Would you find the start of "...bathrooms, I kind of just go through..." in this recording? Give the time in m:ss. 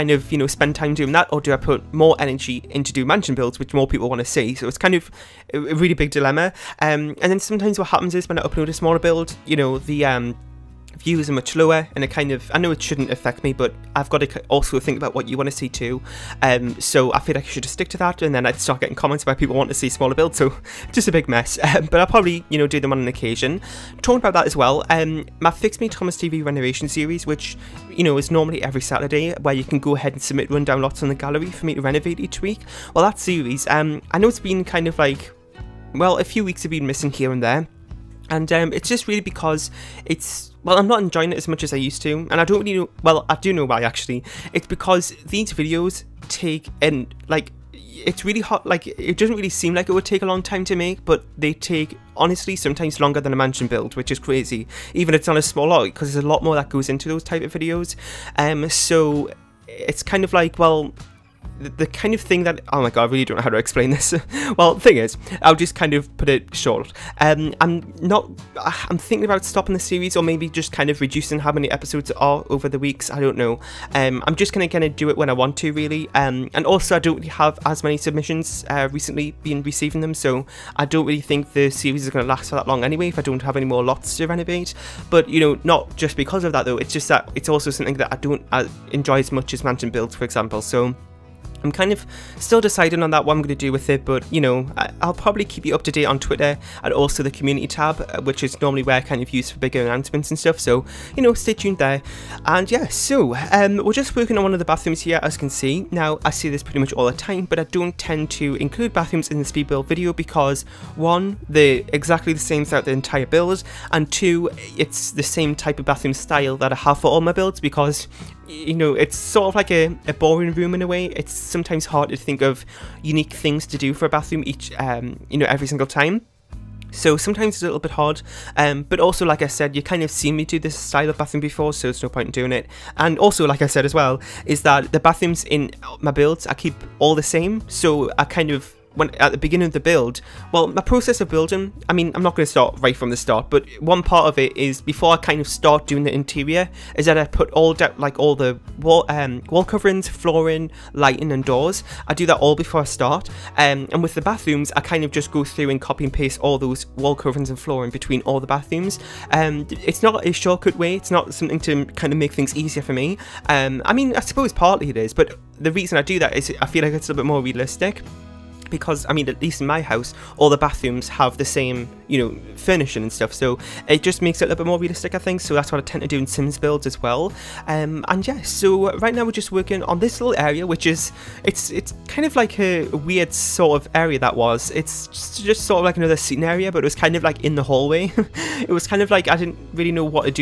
2:34.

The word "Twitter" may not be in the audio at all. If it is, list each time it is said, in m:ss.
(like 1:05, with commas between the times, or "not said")
1:36.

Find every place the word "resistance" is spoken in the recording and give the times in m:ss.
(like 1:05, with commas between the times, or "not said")
not said.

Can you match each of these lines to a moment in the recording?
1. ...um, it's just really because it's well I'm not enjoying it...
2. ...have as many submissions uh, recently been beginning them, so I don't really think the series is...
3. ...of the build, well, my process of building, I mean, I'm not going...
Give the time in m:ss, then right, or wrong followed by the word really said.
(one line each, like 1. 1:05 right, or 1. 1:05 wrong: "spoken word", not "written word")
1. 0:38 right
2. 1:17 wrong: "receiving", not "beginning"
3. 2:19 right.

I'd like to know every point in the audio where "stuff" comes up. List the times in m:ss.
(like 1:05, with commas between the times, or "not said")
1:40, 2:53.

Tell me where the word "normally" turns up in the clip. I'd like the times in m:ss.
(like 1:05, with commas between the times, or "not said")
0:28, 1:38.